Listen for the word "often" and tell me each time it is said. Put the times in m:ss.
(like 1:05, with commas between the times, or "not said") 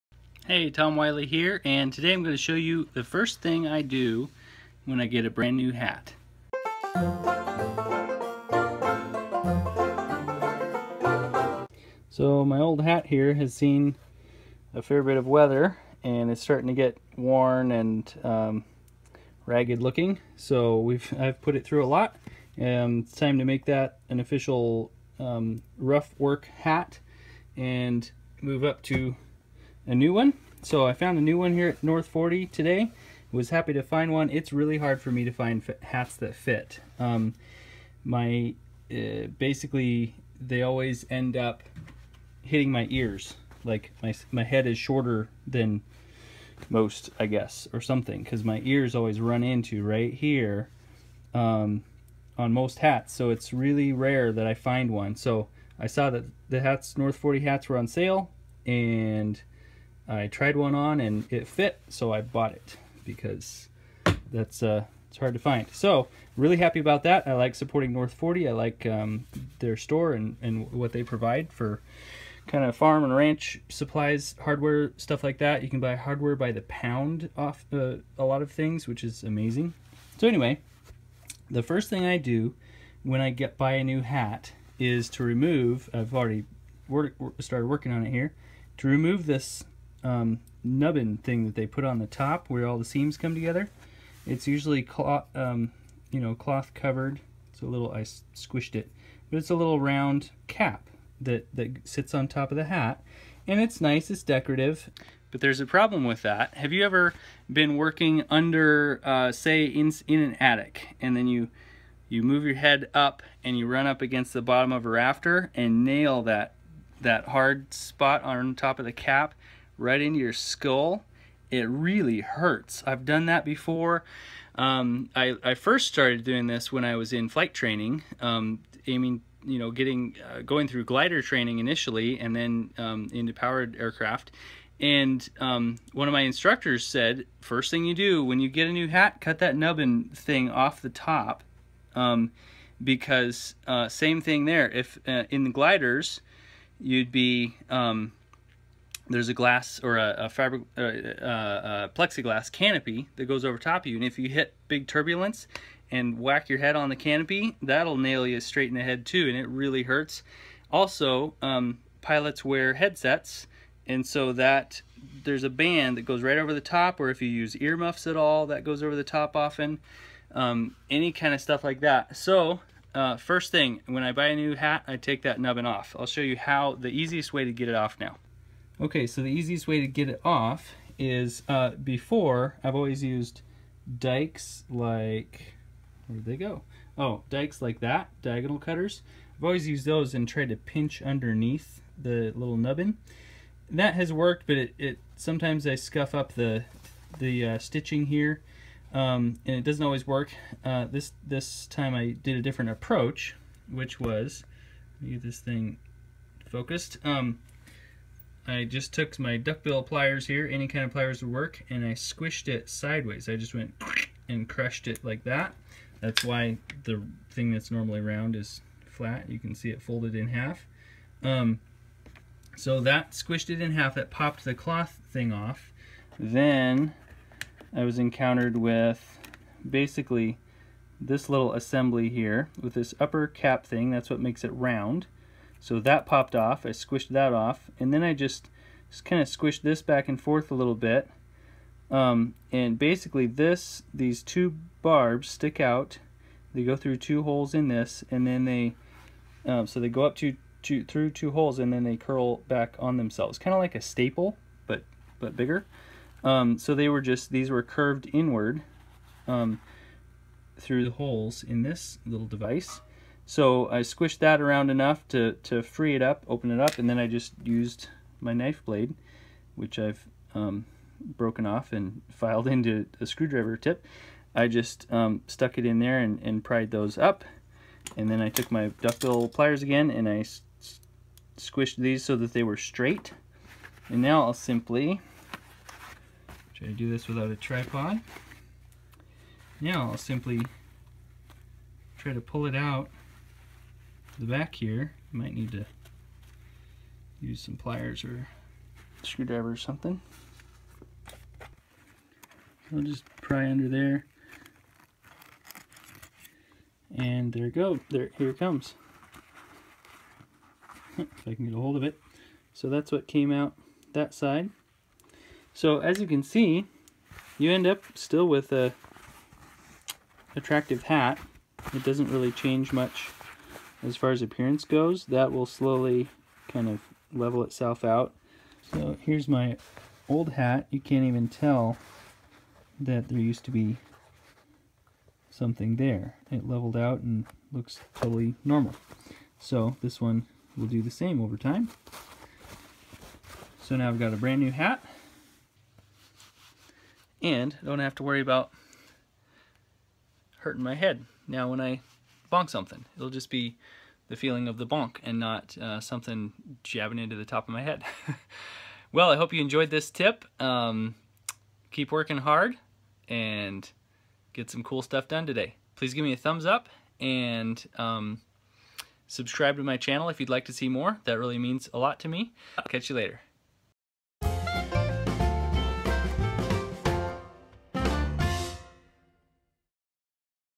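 2:49.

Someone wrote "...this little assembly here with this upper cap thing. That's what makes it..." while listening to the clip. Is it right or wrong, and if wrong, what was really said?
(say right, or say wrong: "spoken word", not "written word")
right.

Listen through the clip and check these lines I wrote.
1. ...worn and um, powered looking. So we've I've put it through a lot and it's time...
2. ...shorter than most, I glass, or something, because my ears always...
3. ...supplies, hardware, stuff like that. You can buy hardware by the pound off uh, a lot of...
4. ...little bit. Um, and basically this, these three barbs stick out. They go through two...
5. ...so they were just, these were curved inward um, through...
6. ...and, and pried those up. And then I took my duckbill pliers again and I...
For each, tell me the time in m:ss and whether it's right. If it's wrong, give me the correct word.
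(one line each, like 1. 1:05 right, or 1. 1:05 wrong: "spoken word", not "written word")
1. 0:17 wrong: "ragged", not "powered"
2. 0:44 wrong: "guess", not "glass"
3. 1:13 right
4. 4:00 wrong: "two", not "three"
5. 4:16 right
6. 4:35 right.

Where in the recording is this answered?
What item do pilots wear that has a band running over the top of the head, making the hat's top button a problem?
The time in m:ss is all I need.
2:42.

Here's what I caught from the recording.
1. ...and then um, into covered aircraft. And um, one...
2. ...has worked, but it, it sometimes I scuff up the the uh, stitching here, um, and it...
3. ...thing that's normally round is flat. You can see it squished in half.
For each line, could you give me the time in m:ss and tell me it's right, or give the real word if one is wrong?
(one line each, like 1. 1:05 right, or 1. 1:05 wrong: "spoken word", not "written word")
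1. 2:12 wrong: "powered", not "covered"
2. 3:13 right
3. 3:37 wrong: "folded", not "squished".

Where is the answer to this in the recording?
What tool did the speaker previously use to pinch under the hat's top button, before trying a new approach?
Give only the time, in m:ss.
3:08.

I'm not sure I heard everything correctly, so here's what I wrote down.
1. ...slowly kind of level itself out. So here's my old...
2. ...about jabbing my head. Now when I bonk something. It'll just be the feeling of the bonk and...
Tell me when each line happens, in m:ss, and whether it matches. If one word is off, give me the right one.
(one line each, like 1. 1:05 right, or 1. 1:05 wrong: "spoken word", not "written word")
1. 5:25 right
2. 5:48 wrong: "hurting", not "jabbing".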